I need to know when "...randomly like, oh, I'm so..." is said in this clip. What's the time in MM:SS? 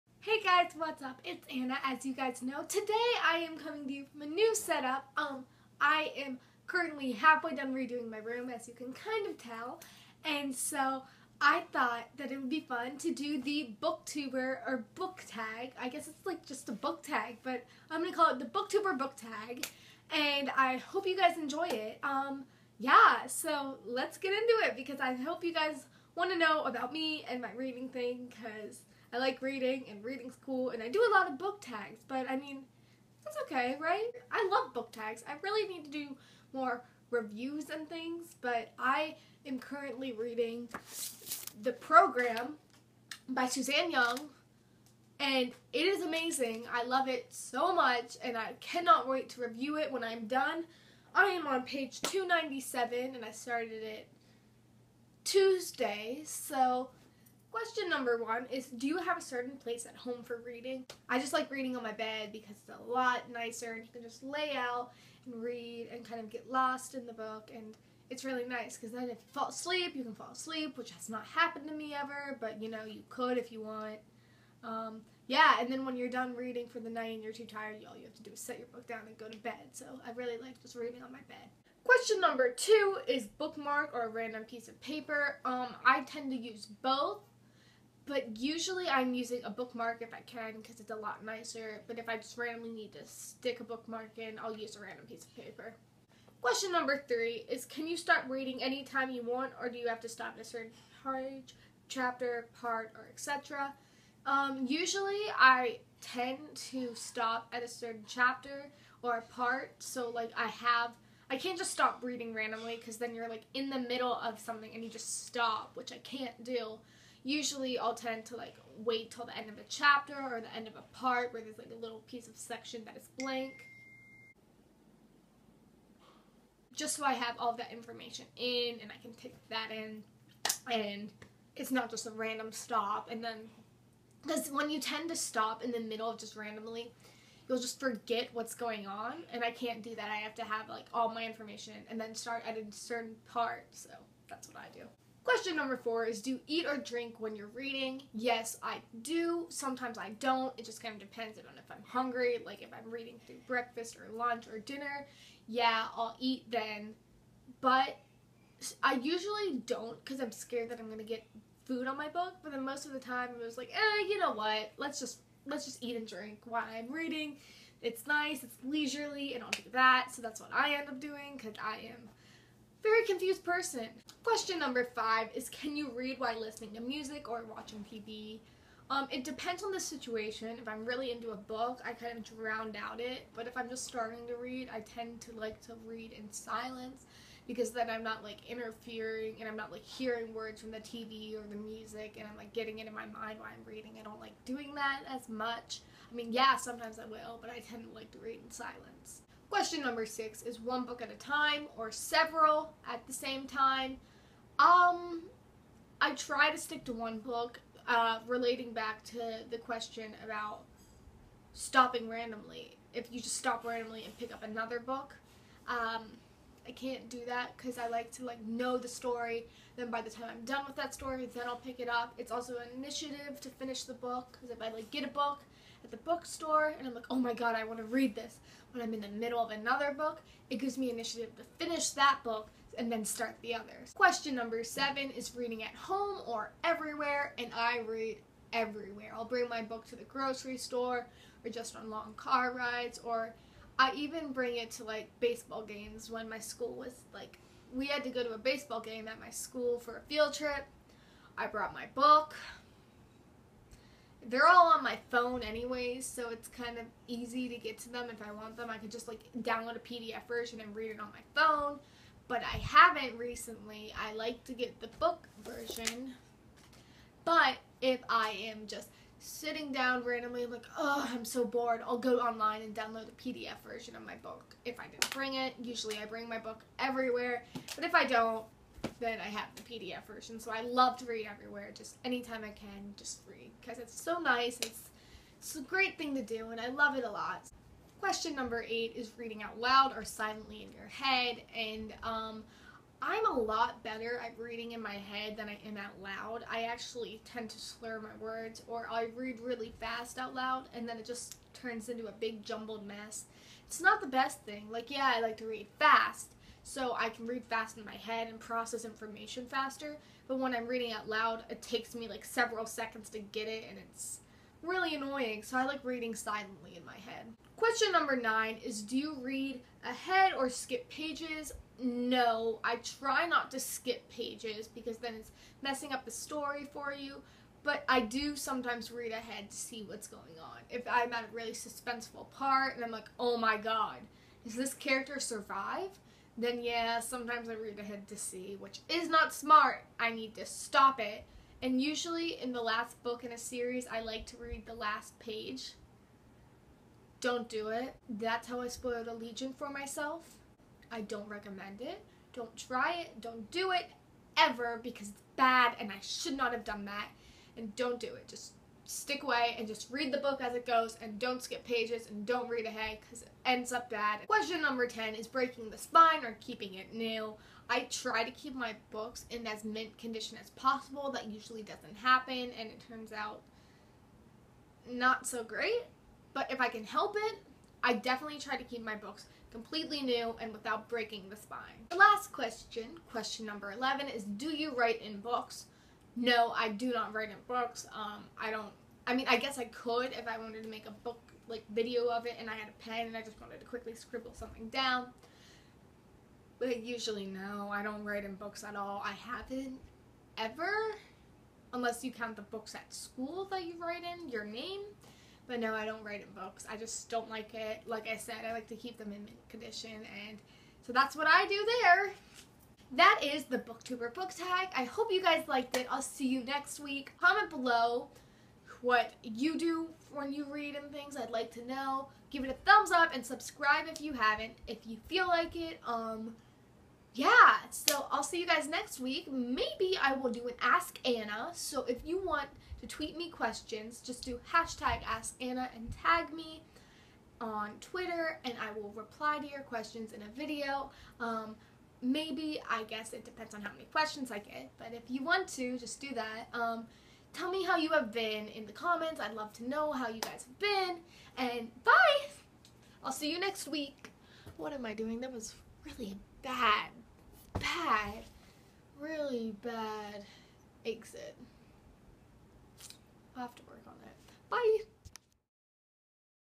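04:30.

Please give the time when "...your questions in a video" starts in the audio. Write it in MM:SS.
07:19.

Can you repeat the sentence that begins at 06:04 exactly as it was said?
Question number 10 is breaking the spine or keeping it new.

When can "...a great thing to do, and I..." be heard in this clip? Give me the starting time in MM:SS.
04:45.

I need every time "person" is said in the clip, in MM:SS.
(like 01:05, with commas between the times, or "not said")
02:53.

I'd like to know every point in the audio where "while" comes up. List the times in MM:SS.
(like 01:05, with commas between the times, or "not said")
02:46, 02:56, 03:13.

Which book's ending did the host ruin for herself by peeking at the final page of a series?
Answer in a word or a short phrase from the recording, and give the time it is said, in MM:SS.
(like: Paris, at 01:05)
Allegiant, at 05:49.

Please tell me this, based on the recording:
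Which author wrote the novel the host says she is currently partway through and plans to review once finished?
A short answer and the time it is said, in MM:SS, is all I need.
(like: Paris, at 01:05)
Suzanne Young, at 00:43.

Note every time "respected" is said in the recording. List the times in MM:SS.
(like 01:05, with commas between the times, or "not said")
not said.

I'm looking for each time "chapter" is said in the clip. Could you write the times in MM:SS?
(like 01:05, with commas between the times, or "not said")
01:41, 01:48, 01:59.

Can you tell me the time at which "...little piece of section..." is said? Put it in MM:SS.
02:01.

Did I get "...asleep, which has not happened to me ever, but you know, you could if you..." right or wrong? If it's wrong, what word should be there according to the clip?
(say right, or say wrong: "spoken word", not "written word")
right.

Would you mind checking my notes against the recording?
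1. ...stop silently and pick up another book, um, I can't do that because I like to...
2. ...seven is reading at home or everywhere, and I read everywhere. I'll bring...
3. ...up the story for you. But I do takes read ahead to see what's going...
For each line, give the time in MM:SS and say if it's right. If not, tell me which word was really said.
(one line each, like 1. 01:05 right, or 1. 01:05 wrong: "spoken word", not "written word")
1. 03:33 wrong: "randomly", not "silently"
2. 03:54 right
3. 05:25 wrong: "sometimes", not "takes".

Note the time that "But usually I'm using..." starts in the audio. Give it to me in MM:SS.
01:28.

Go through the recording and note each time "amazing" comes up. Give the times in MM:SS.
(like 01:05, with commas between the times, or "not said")
00:46.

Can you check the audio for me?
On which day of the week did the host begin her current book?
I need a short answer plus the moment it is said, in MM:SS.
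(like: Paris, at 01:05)
Tuesday, at 00:55.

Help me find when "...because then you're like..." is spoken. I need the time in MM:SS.
01:52.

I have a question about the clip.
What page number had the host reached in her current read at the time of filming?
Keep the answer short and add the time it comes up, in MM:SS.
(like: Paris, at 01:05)
297, at 00:52.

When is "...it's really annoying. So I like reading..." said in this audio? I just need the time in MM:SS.
05:13.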